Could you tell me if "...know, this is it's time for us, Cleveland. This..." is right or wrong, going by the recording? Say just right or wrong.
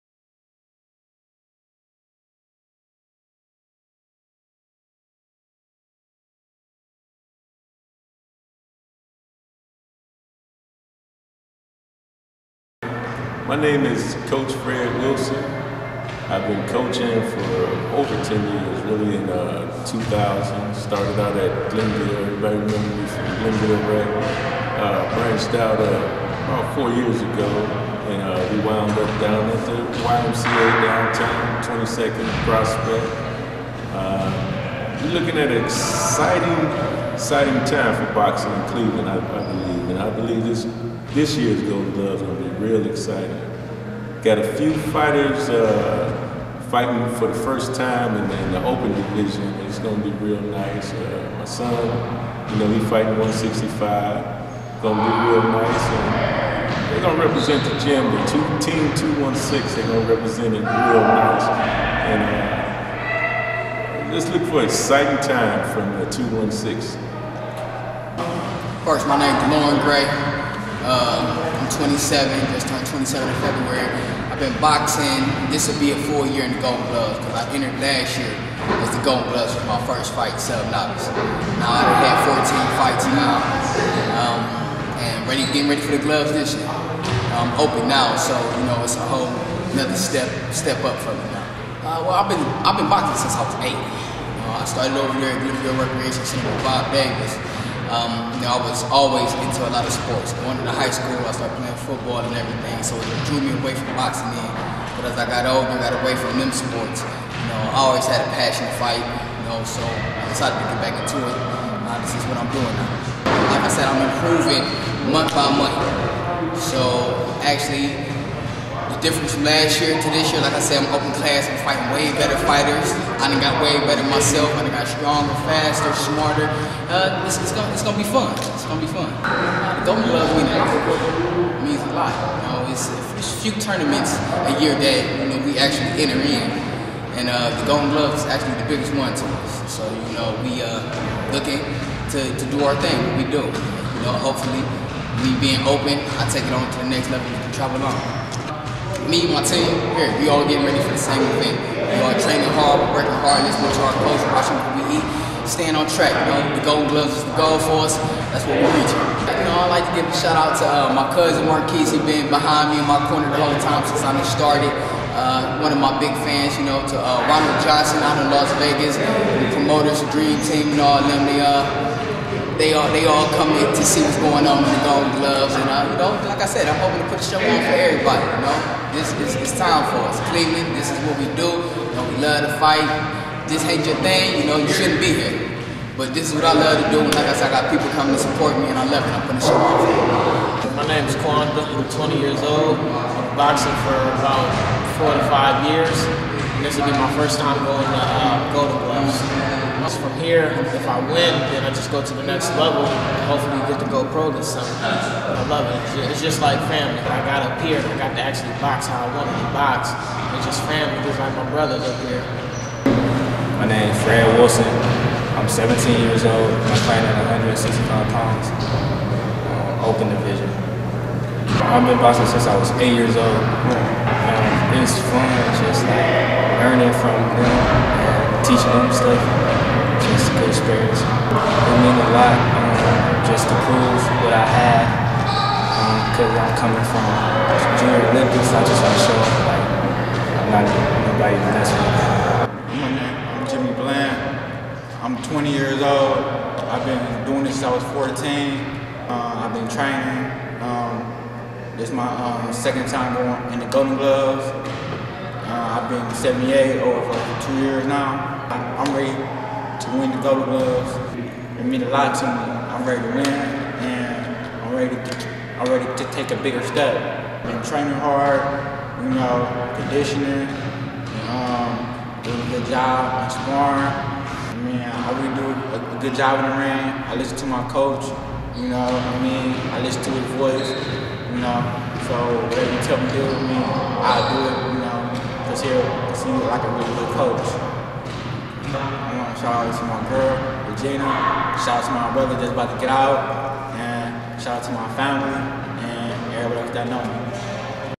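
right.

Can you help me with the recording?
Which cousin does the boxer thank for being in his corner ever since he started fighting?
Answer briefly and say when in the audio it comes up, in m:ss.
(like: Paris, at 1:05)
Marquise, at 2:41.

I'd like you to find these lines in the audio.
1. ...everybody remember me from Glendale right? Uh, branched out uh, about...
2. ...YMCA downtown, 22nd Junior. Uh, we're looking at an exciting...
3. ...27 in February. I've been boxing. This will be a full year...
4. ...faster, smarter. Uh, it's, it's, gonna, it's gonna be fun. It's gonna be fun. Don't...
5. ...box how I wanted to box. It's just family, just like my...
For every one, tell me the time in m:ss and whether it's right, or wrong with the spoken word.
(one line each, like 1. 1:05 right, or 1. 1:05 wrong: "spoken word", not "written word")
1. 0:22 right
2. 0:29 wrong: "Prospect", not "Junior"
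3. 1:12 right
4. 2:05 right
5. 3:28 right.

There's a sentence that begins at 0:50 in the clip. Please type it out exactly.
Uh, my son, you know, he's fighting 165.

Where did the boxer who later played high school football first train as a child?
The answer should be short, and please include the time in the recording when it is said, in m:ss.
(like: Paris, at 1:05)
Bloomfield Recreation Center, at 1:35.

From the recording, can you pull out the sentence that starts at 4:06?
I've been doing this since I was 14.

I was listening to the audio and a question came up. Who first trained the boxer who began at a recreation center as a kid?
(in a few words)
Bob Davis.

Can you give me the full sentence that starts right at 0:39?
And I believe this this year's Golden Glove's gonna be real exciting.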